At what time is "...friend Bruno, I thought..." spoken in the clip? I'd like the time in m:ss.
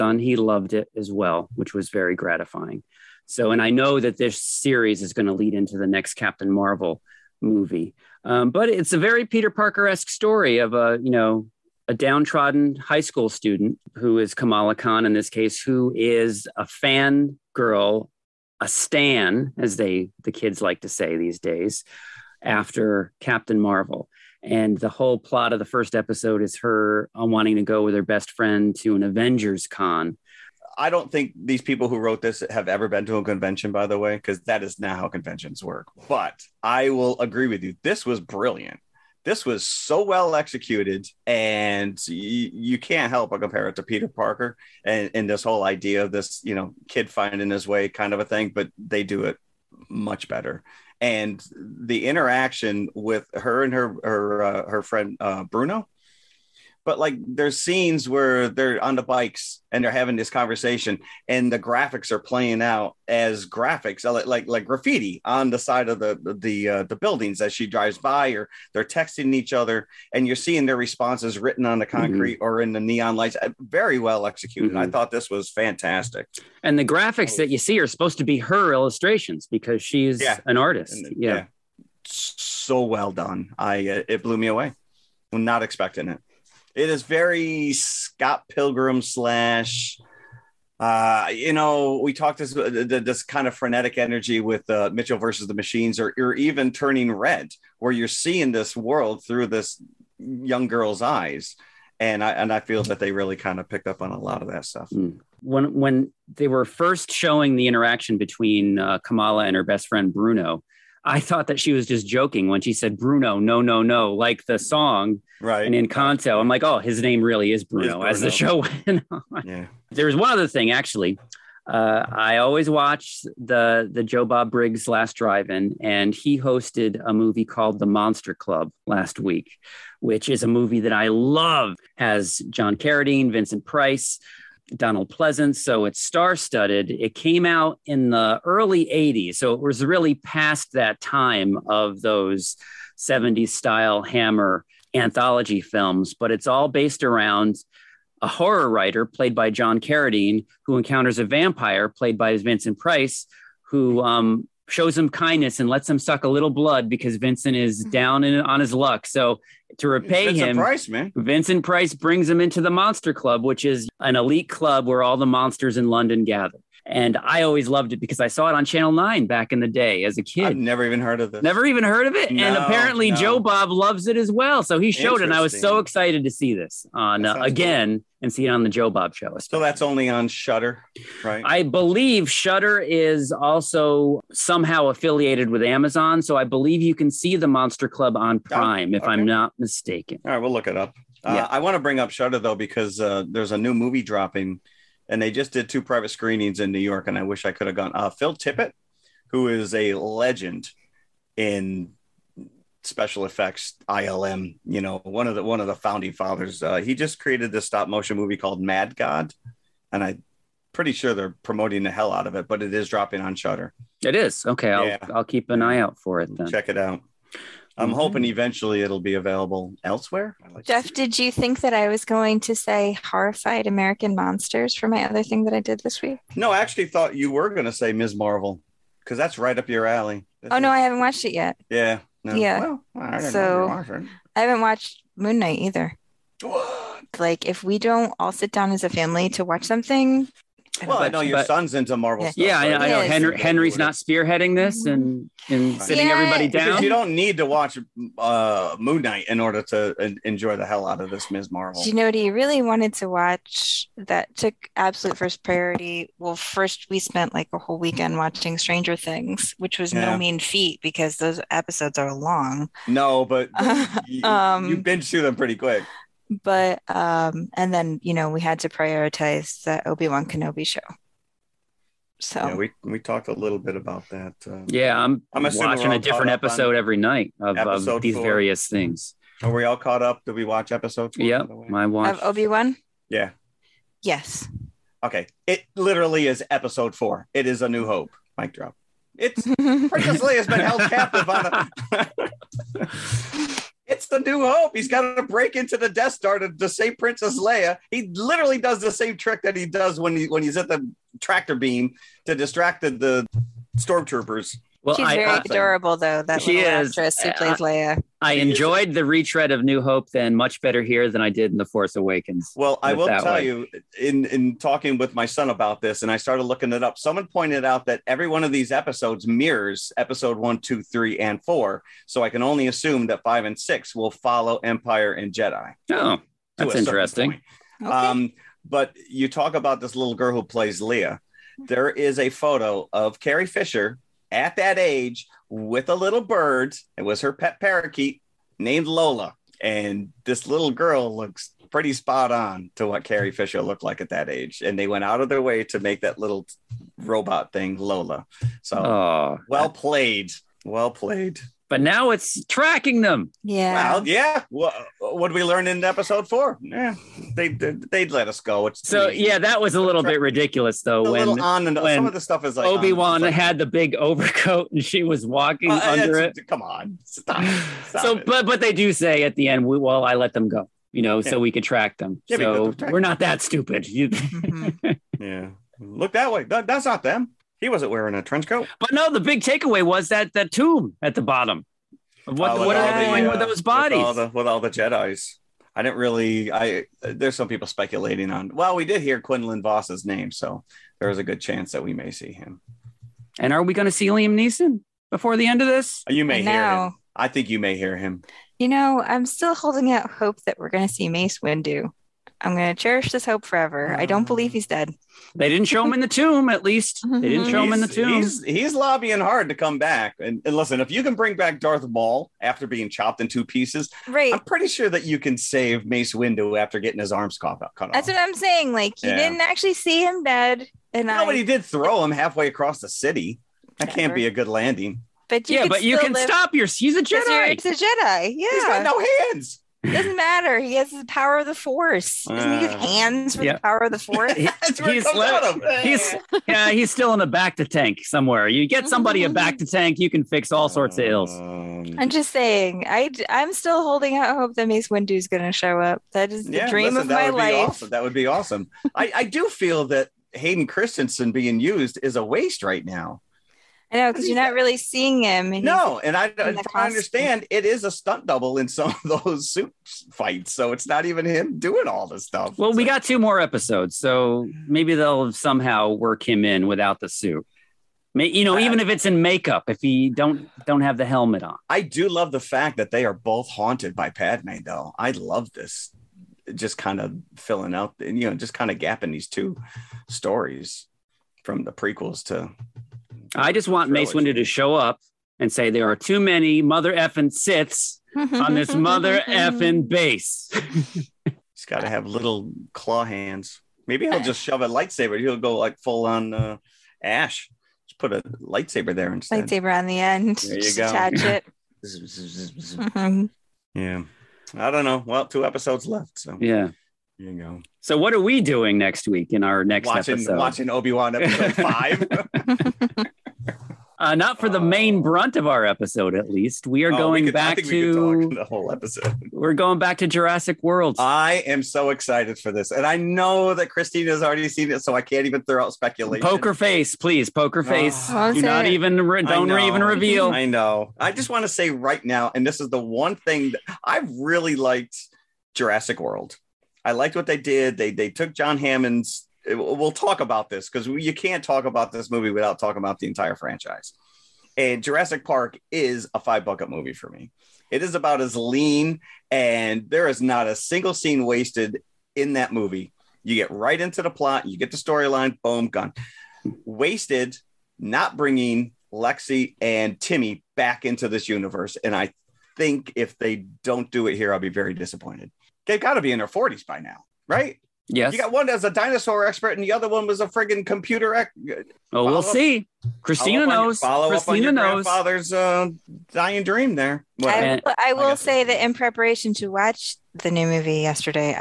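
1:49.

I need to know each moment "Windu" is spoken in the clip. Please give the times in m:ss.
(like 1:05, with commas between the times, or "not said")
6:41, 6:56, 8:04.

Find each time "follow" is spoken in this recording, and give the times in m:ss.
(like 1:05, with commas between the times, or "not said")
5:24, 9:33.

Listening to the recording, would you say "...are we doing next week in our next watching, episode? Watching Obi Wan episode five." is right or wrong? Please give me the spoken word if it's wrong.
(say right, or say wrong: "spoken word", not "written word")
right.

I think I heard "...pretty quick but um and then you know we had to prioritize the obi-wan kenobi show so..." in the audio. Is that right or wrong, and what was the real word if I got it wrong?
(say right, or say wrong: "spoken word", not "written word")
right.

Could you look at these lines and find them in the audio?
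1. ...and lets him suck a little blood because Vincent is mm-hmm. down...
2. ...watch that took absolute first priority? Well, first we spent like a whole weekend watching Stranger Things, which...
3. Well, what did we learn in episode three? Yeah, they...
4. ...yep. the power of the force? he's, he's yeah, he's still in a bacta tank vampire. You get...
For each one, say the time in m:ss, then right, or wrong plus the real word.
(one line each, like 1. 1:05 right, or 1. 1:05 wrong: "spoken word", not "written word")
1. 2:35 right
2. 4:13 right
3. 5:54 wrong: "four", not "three"
4. 7:13 wrong: "somewhere", not "vampire".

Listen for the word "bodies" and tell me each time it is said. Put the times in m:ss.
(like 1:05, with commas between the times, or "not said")
6:23.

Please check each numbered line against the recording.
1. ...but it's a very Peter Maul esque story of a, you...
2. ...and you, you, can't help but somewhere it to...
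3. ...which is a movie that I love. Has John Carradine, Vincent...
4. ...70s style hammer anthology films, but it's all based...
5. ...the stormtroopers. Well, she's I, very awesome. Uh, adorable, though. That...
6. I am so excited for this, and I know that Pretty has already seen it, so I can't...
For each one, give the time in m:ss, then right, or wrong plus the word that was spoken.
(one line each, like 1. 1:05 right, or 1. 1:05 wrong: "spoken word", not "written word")
1. 0:08 wrong: "Parker", not "Maul"
2. 0:41 wrong: "compare", not "somewhere"
3. 2:10 right
4. 2:22 right
5. 5:02 right
6. 8:40 wrong: "Christine", not "Pretty".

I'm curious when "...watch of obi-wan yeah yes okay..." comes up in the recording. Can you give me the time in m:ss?
4:41.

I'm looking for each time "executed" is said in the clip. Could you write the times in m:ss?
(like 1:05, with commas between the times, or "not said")
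0:40, 1:14.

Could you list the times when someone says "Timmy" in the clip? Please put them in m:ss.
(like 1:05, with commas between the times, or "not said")
9:20.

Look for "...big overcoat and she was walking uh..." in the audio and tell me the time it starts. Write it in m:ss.
6:03.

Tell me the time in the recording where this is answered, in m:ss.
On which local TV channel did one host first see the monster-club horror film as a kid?
2:48.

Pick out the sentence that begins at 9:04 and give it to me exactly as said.
And Jurassic Park is a five bucket movie for me.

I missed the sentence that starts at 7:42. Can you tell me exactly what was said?
Well, we got two more episodes, so maybe they'll somehow work him in without the suit.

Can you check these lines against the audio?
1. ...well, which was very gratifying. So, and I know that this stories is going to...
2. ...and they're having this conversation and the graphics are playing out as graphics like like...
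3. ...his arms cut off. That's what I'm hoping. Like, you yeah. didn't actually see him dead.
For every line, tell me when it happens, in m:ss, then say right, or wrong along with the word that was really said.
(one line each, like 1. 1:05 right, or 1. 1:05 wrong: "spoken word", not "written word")
1. 0:01 wrong: "series", not "stories"
2. 0:59 right
3. 6:57 wrong: "saying", not "hoping".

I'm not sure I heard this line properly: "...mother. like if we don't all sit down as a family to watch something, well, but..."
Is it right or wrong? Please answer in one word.
wrong.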